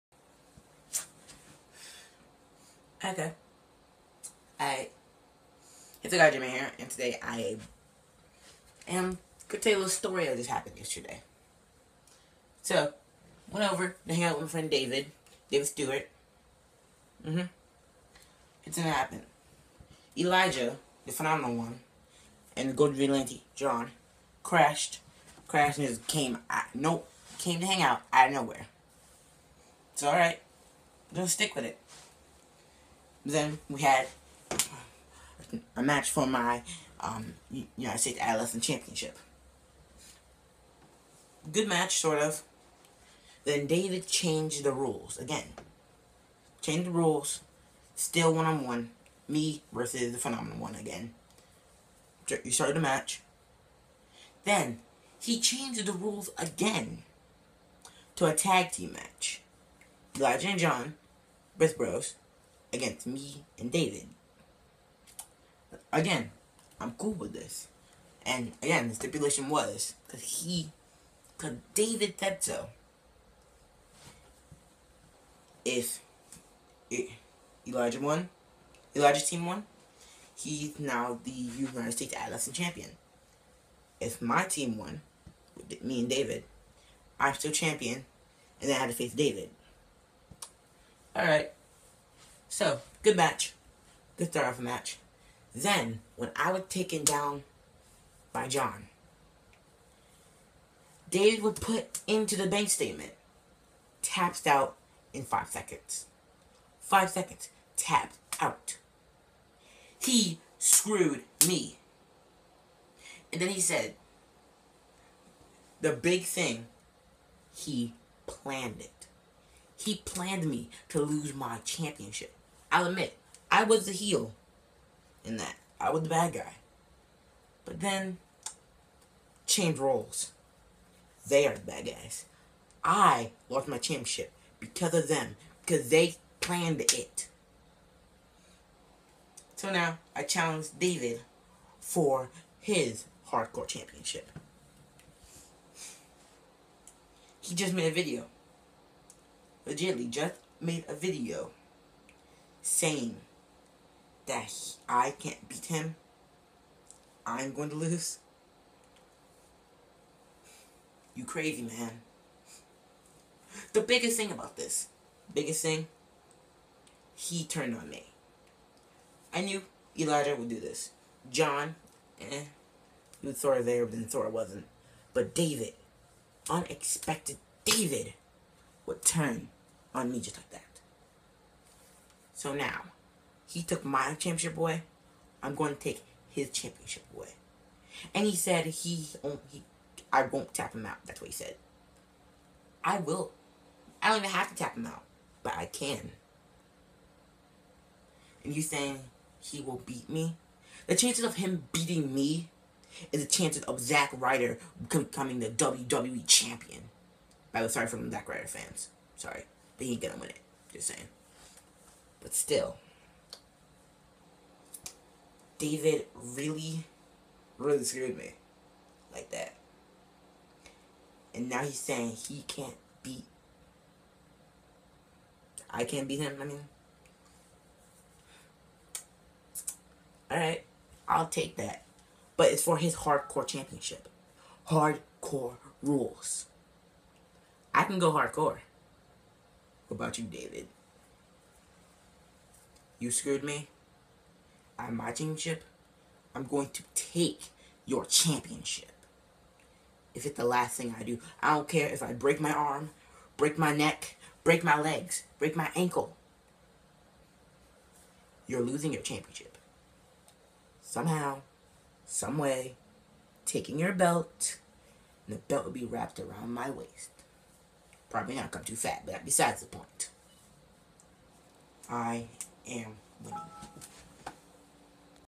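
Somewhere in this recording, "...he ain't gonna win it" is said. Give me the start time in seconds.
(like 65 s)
209 s.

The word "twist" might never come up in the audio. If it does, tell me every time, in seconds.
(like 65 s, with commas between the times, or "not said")
not said.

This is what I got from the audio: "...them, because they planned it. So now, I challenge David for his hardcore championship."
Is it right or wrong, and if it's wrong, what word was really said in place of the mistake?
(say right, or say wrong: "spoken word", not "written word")
right.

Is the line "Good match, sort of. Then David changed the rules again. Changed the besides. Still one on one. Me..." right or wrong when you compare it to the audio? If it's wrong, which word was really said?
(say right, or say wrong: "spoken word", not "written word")
wrong: "rules", not "besides".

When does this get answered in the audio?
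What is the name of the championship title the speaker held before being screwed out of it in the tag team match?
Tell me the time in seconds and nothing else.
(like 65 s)
37 s.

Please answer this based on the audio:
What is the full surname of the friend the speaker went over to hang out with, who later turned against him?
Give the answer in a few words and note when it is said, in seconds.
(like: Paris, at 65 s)
Stewart, at 15 s.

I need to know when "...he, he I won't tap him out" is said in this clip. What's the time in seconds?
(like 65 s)
188 s.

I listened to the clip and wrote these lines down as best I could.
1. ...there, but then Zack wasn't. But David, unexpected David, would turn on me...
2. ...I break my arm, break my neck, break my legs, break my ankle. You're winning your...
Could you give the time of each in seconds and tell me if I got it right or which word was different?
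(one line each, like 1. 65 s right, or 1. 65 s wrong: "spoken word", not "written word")
1. 173 s wrong: "Thor", not "Zack"
2. 252 s wrong: "losing", not "winning".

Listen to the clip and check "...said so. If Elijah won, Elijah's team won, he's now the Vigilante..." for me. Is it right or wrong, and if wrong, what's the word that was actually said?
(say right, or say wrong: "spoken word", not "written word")
wrong: "United", not "Vigilante".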